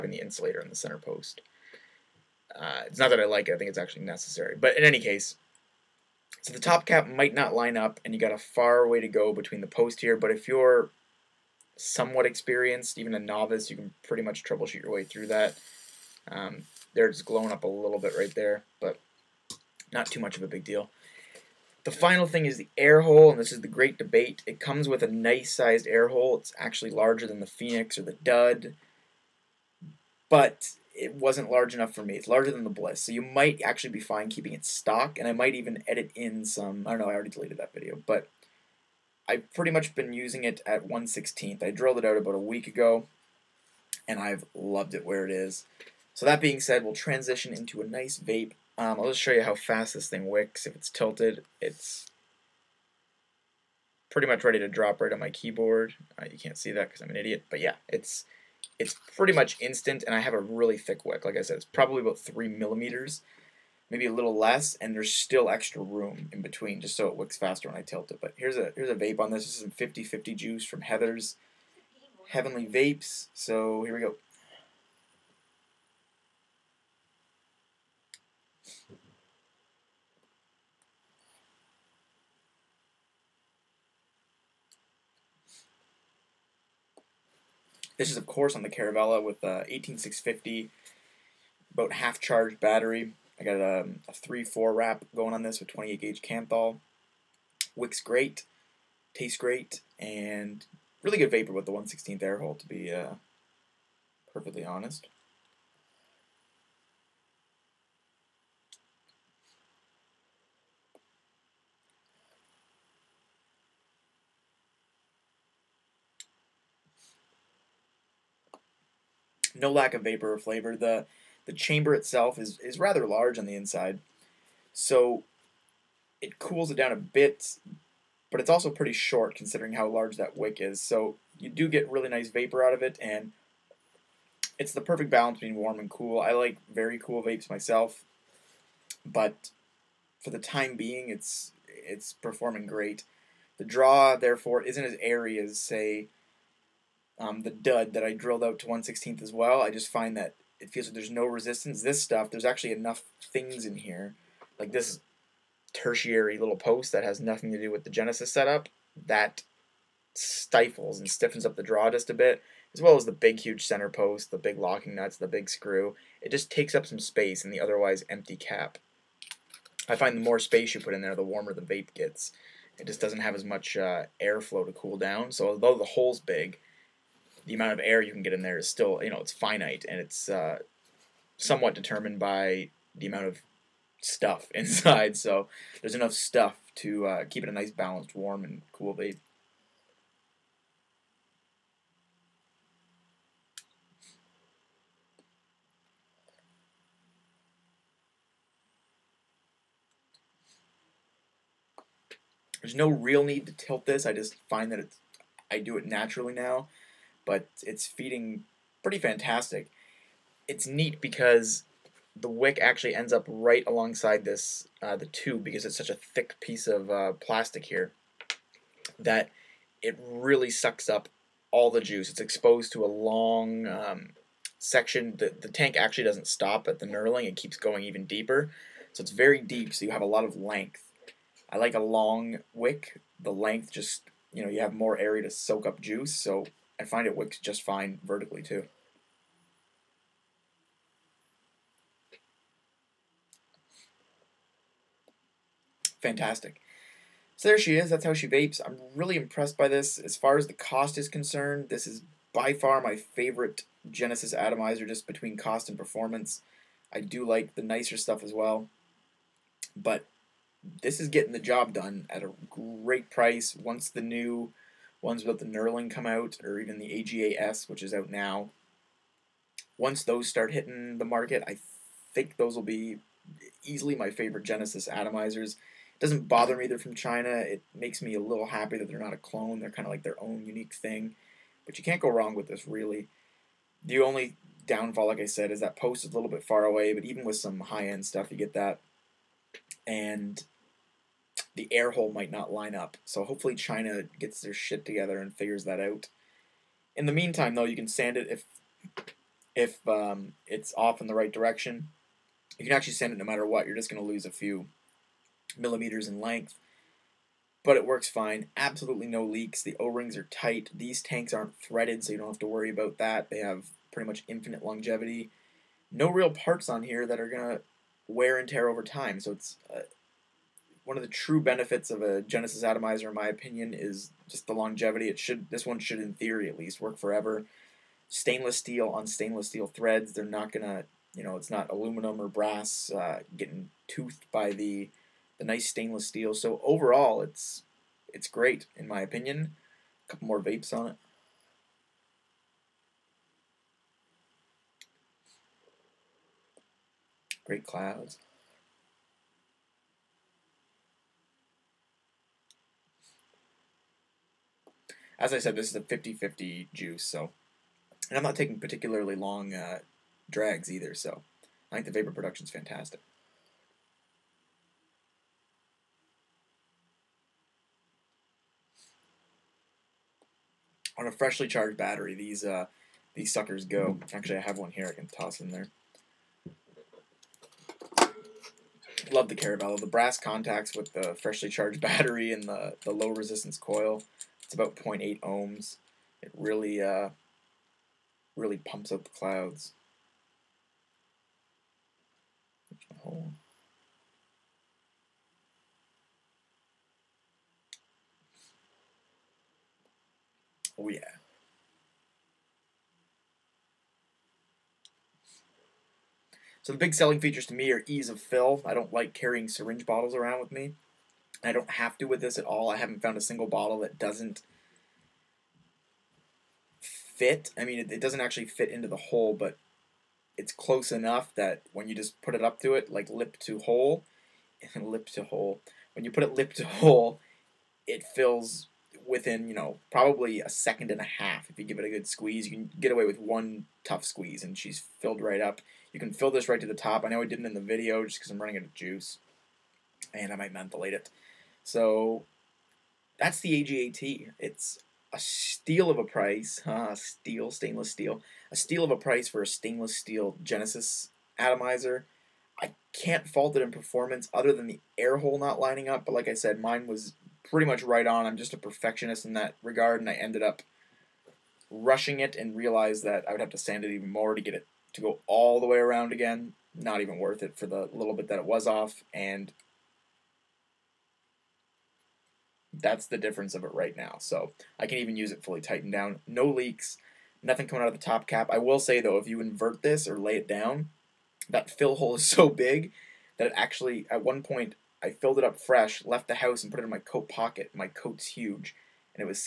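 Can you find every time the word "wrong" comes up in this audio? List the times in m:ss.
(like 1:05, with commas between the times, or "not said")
4:42.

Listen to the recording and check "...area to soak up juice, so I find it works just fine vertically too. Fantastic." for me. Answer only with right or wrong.
right.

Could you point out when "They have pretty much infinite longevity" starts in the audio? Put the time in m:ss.
5:13.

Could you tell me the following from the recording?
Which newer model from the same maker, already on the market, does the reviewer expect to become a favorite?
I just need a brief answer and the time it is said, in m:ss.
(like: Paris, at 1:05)
AGA-S, at 4:26.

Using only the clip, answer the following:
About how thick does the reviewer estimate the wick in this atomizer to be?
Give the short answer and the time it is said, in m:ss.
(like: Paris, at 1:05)
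3 millimeters, at 1:02.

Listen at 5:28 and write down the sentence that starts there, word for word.
Stainless steel on stainless steel threads.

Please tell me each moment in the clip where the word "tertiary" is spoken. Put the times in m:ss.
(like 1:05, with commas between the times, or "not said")
2:35.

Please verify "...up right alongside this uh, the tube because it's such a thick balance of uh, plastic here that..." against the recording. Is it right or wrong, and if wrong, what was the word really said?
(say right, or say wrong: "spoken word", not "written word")
wrong: "piece", not "balance".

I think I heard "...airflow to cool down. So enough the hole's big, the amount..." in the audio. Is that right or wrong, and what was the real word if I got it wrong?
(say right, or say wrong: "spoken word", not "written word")
wrong: "although", not "enough".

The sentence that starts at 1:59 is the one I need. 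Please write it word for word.
no lack of vapor or flavor.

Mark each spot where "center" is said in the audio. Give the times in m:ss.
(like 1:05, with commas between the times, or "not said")
0:00, 2:43.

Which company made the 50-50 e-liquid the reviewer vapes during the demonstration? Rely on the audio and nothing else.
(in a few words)
Heather's Heavenly Vapes.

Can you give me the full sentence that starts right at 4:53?
So hopefully China gets their shit together and figures that out.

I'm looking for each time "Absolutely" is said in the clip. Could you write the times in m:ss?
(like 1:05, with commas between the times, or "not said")
5:08.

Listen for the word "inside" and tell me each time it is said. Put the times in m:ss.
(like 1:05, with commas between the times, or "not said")
2:03, 3:04.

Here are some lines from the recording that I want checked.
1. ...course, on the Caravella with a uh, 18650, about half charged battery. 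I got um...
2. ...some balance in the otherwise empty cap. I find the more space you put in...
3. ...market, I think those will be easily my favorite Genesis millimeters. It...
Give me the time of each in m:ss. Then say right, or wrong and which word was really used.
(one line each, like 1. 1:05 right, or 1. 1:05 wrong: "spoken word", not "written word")
1. 1:28 right
2. 2:46 wrong: "space", not "balance"
3. 4:31 wrong: "atomizers", not "millimeters".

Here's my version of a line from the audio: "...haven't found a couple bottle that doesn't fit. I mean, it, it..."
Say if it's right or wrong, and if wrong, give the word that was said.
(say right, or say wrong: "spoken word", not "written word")
wrong: "single", not "couple".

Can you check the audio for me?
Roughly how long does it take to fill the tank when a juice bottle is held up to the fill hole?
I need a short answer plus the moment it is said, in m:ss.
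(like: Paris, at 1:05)
a second and a half, at 7:10.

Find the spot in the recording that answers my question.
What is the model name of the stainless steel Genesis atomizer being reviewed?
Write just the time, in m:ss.
7:23.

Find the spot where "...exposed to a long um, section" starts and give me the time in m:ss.
3:42.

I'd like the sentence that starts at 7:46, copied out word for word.
Not even worth it for the little bit that it was off, and that's the difference of it right now.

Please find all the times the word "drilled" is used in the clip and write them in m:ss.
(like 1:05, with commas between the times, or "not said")
0:41, 2:28.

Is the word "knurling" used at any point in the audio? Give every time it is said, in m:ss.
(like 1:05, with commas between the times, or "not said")
3:46, 4:25.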